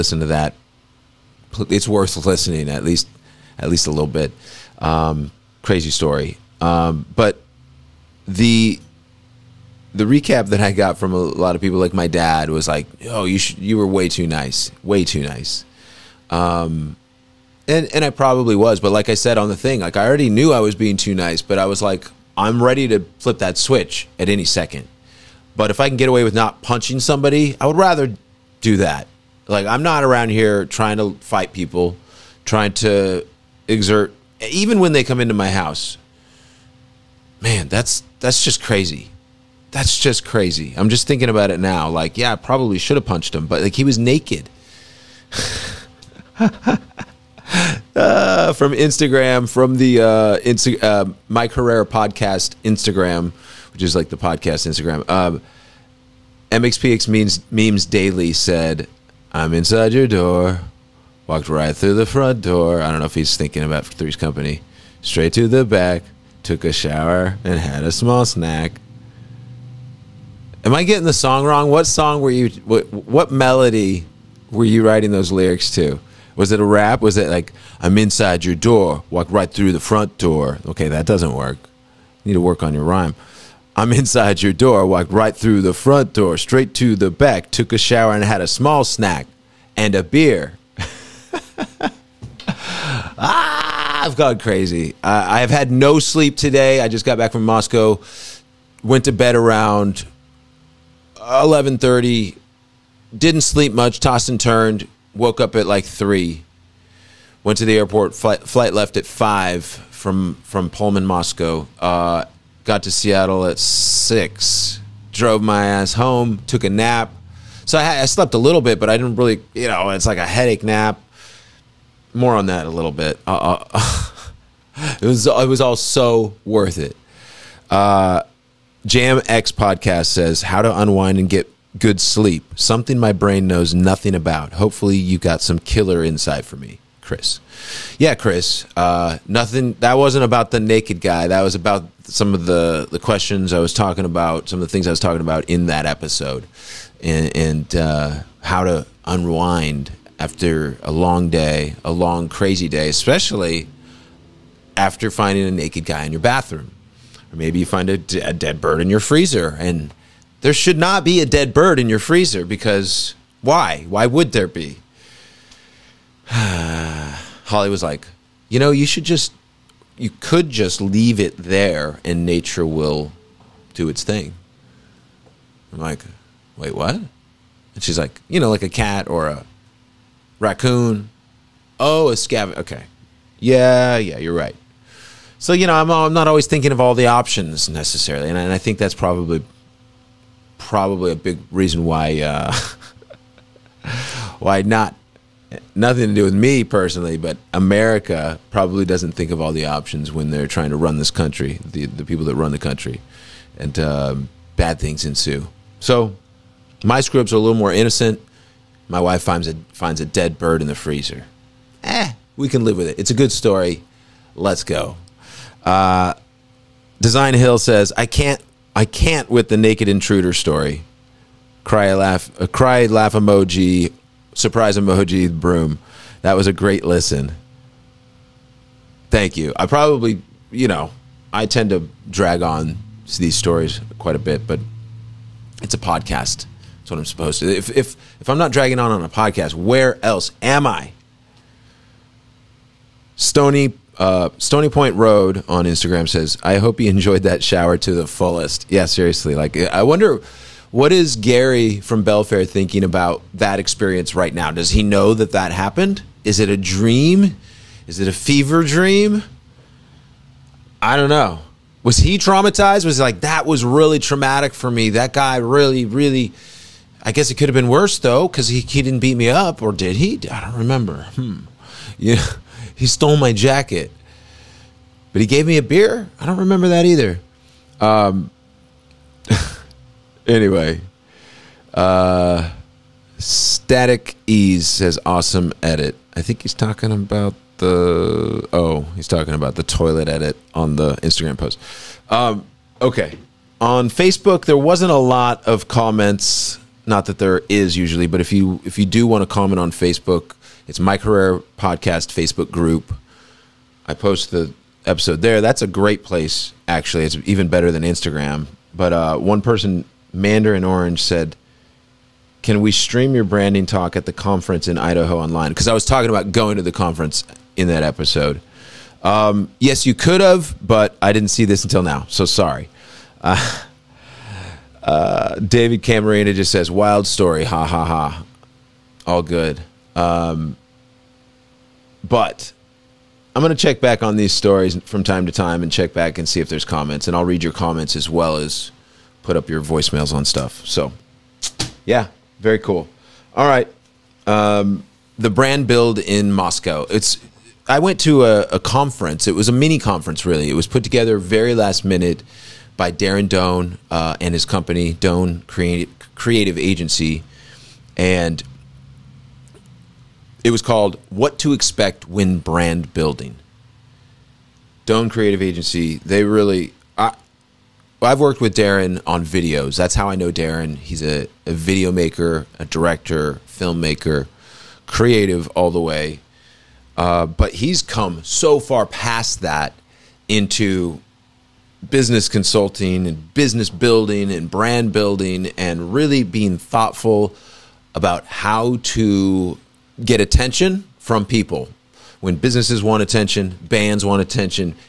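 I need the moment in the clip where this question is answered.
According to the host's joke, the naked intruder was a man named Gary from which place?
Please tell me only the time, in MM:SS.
04:12.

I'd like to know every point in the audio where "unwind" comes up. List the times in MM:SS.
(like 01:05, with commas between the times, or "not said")
02:10, 02:29.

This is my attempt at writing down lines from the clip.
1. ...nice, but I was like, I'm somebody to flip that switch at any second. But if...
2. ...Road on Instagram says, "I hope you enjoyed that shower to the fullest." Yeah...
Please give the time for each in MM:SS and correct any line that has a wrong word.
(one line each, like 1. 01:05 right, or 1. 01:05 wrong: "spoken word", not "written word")
1. 00:21 wrong: "ready", not "somebody"
2. 04:04 right.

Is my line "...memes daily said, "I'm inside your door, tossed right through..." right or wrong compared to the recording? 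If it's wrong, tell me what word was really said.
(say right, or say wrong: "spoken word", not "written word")
wrong: "walked", not "tossed".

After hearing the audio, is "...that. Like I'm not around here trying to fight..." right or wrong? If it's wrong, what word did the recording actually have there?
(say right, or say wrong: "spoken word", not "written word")
right.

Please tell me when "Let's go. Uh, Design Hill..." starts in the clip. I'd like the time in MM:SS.
03:34.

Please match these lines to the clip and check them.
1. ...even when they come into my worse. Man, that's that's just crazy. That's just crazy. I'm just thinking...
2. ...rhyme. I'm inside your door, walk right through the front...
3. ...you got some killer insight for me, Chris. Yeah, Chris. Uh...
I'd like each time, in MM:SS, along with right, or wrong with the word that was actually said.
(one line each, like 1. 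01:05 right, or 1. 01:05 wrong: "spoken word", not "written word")
1. 00:34 wrong: "house", not "worse"
2. 01:22 right
3. 02:14 right.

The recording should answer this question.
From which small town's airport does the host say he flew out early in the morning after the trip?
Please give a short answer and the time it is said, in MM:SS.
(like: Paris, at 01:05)
Pullman, at 01:50.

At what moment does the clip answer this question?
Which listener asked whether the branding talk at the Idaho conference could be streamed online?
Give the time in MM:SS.
05:10.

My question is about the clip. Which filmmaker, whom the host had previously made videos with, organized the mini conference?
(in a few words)
Darren Doane.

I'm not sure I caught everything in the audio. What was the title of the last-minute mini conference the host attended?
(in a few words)
What to Expect When Brand Building.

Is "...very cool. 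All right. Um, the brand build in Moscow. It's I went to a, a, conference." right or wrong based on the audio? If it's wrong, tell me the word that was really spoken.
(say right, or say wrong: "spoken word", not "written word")
right.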